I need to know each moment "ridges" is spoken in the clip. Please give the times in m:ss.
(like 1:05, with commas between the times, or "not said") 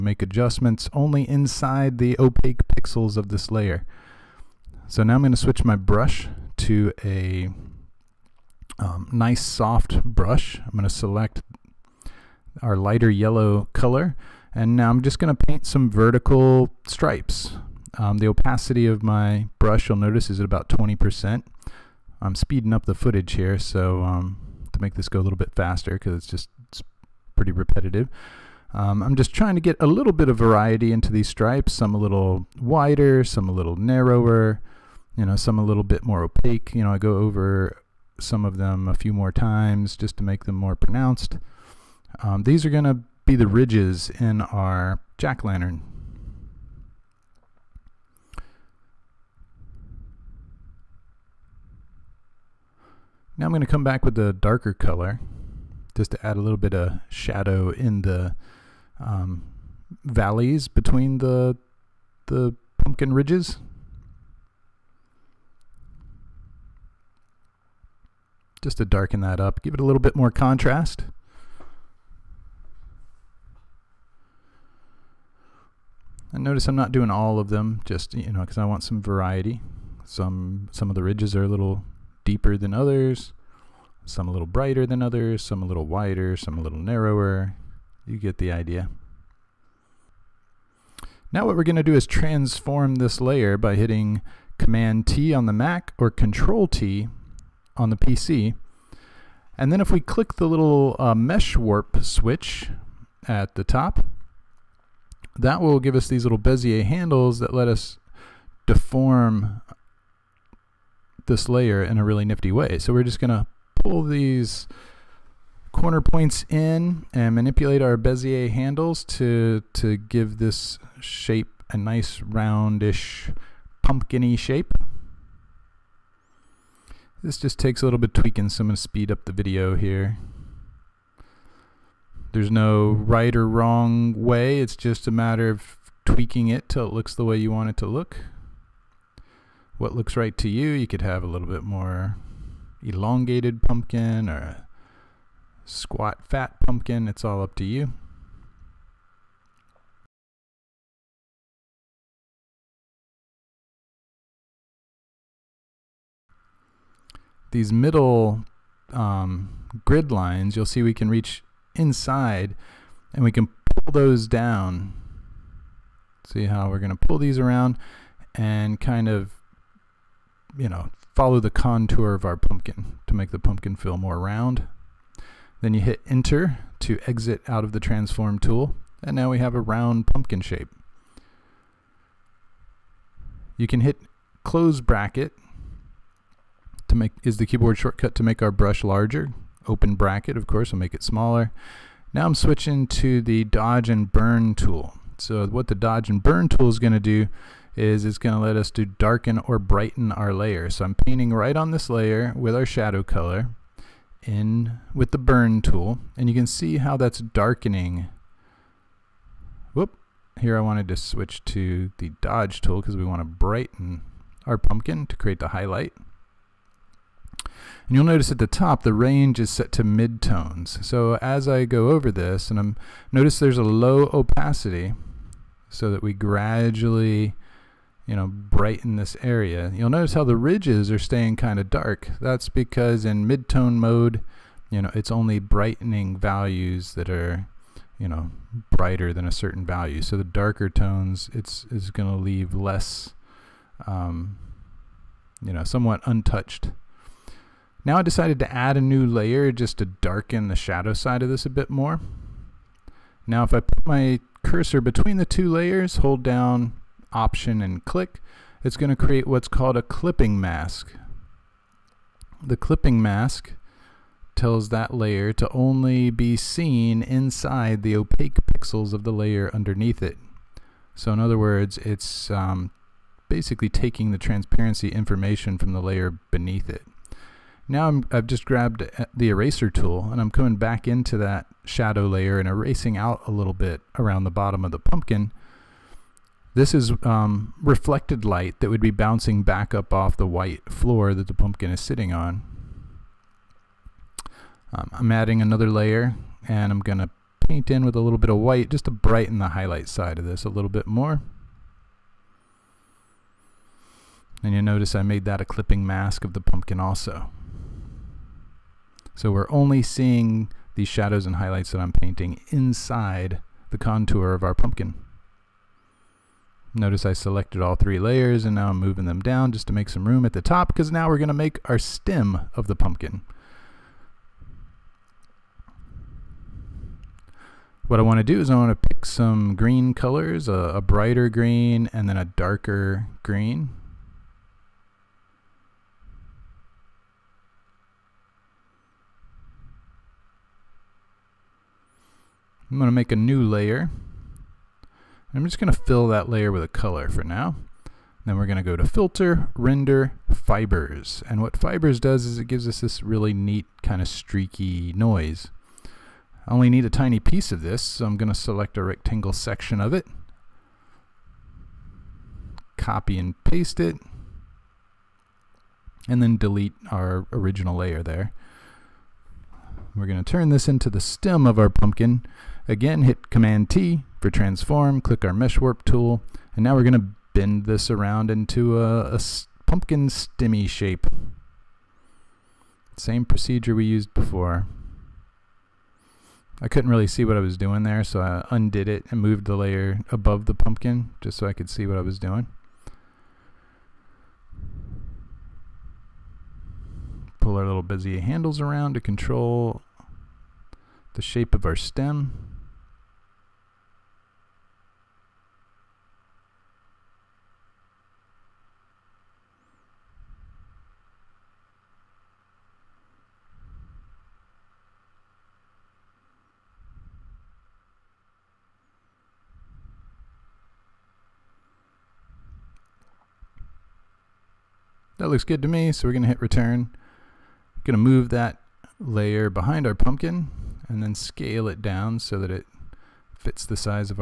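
0:43, 1:03, 1:21, 3:50.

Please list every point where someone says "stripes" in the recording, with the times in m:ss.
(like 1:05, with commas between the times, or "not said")
0:16, 0:31.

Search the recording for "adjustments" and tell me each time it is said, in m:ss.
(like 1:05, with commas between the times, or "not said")
0:00.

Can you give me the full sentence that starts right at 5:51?
And what Fibers does is it gives us this really neat kind of streaky noise.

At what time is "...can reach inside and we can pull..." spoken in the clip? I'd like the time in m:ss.
2:40.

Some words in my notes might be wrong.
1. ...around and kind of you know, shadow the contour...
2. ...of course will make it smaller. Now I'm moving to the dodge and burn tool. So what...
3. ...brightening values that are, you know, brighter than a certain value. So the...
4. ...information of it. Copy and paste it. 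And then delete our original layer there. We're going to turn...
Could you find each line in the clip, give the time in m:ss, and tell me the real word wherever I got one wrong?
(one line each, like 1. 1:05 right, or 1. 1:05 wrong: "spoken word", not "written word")
1. 2:47 wrong: "follow", not "shadow"
2. 3:10 wrong: "switching", not "moving"
3. 3:55 right
4. 5:59 wrong: "section", not "information".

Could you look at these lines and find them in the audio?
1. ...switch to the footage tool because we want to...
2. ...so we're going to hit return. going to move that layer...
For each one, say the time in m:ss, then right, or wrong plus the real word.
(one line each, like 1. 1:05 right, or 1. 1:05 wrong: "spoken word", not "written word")
1. 3:30 wrong: "dodge", not "footage"
2. 7:05 right.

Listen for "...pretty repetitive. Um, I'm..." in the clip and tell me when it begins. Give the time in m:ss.
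0:27.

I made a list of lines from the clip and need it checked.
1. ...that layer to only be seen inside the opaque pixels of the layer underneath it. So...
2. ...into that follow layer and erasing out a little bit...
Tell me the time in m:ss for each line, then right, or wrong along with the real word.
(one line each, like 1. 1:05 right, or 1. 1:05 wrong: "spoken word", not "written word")
1. 4:24 right
2. 4:40 wrong: "shadow", not "follow".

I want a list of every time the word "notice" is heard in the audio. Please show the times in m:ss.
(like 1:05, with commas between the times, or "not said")
0:19, 1:16, 3:38, 3:43, 3:49, 5:04, 5:16.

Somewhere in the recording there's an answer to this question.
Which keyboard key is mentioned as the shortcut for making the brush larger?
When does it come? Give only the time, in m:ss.
3:04.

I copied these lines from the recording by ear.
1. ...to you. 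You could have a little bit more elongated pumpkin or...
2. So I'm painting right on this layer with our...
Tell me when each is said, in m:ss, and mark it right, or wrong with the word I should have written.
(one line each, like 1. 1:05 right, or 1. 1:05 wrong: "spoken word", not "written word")
1. 2:20 right
2. 3:20 right.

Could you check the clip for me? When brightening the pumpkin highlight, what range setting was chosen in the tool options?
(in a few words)
midtones.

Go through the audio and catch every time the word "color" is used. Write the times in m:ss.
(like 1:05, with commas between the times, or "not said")
0:13, 0:54, 3:23, 5:29, 5:46.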